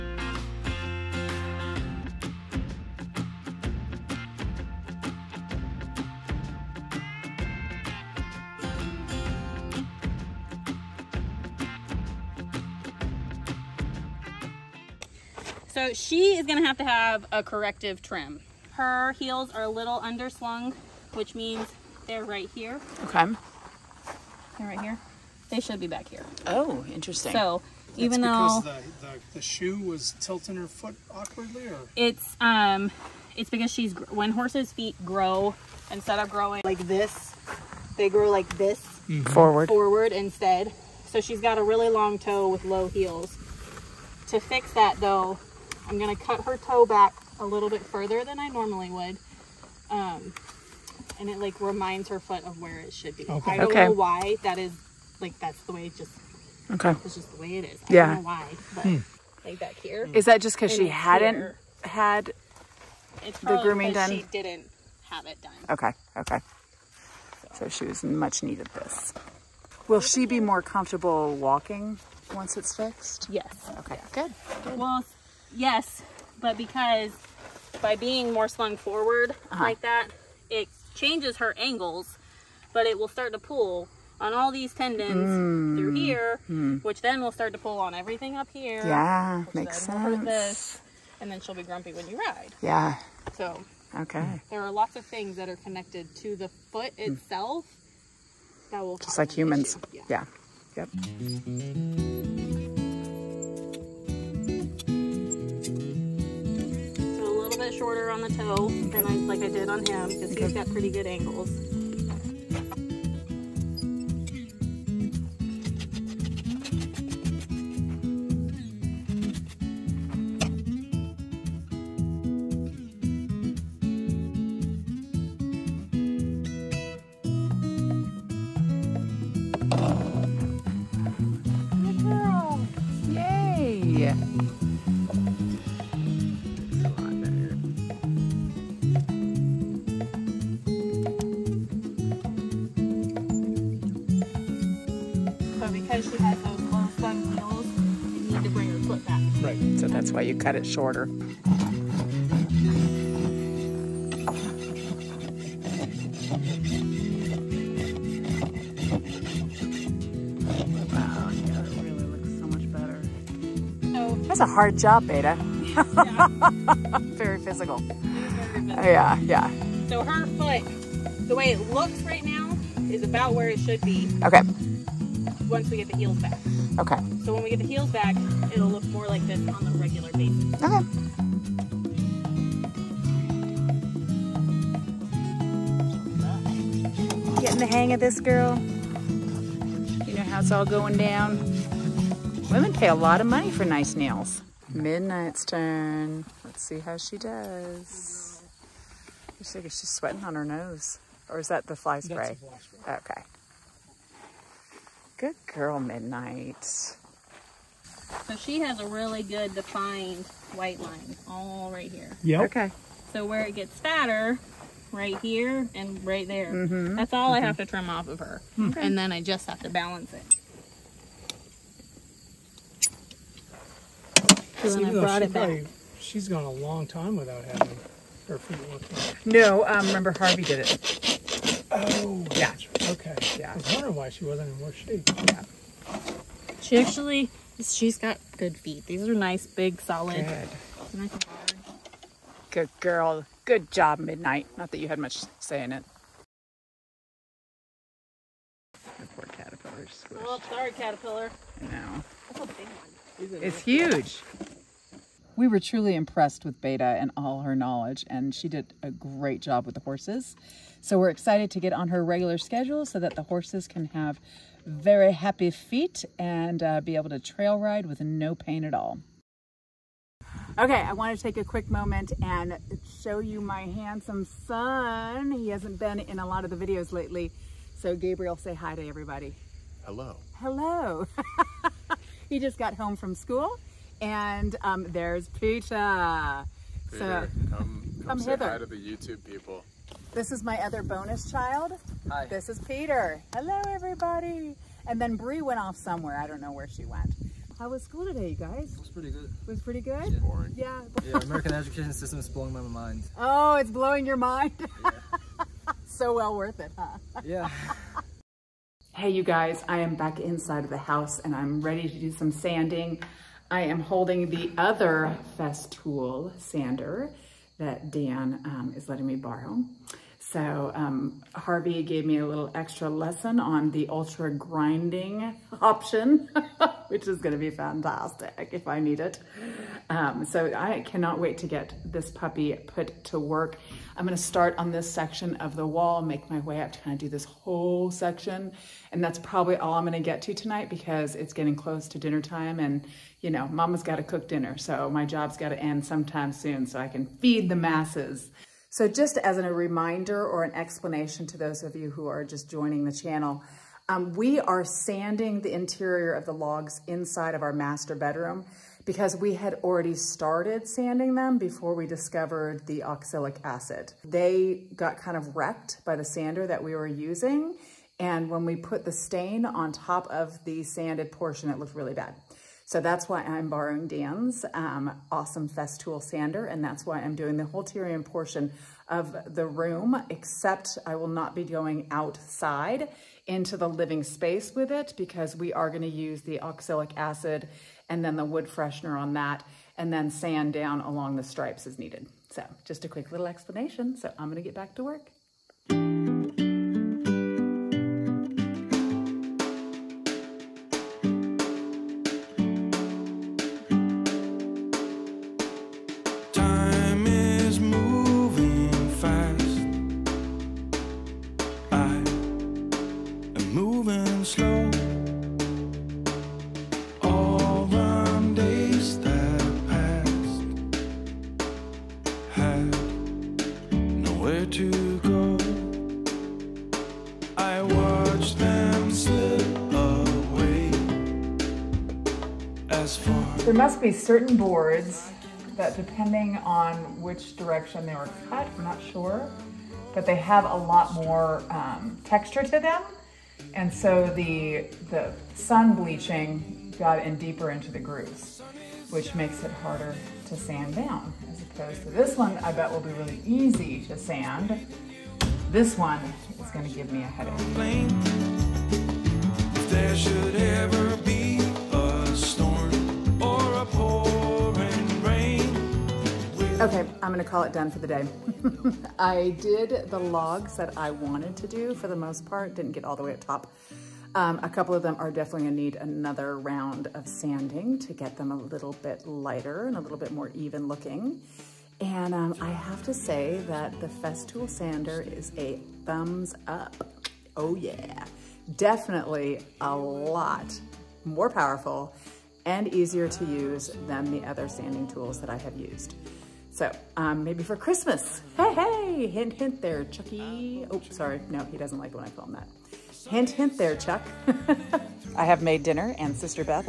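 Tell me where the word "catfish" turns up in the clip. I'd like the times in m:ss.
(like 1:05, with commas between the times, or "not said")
not said.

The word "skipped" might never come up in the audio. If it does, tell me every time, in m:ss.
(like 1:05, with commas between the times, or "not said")
not said.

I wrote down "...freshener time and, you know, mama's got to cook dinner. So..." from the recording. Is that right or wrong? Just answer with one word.
wrong.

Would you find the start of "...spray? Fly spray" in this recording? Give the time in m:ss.
3:22.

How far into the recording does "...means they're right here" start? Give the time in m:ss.
0:21.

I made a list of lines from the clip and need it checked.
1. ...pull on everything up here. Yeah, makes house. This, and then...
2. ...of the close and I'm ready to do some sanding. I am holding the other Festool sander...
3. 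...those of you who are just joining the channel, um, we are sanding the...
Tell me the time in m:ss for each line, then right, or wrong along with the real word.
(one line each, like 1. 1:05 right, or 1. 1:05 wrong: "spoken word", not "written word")
1. 1:27 wrong: "sense", not "house"
2. 5:10 wrong: "house", not "close"
3. 5:51 right.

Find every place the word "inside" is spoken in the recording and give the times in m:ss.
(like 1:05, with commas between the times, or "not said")
5:10, 5:56.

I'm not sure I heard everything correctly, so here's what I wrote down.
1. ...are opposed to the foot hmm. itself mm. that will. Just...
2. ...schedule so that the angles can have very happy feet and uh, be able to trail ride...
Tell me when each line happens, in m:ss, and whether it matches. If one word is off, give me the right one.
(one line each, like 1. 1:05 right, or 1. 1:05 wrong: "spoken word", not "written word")
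1. 1:35 wrong: "connected", not "opposed"
2. 4:22 wrong: "horses", not "angles".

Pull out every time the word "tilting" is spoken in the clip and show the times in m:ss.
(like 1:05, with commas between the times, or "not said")
0:30.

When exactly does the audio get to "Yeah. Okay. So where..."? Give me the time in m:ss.
3:32.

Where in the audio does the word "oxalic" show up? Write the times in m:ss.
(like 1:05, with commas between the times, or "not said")
6:02, 6:26.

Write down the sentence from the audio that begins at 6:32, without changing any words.
So just a quick little explanation.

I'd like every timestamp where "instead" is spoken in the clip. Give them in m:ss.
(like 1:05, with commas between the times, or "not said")
0:35, 0:40.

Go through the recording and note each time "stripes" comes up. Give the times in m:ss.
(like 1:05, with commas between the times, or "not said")
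6:31.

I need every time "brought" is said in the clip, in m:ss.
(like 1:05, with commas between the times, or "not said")
3:44.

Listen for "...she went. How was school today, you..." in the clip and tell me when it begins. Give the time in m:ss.
4:56.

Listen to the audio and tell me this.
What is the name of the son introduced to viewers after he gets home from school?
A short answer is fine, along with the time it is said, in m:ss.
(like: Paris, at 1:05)
Gabriel, at 4:37.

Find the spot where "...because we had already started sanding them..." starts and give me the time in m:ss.
5:58.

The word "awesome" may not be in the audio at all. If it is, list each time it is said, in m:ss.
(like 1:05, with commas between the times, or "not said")
6:15.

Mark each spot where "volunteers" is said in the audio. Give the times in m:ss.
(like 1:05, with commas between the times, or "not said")
not said.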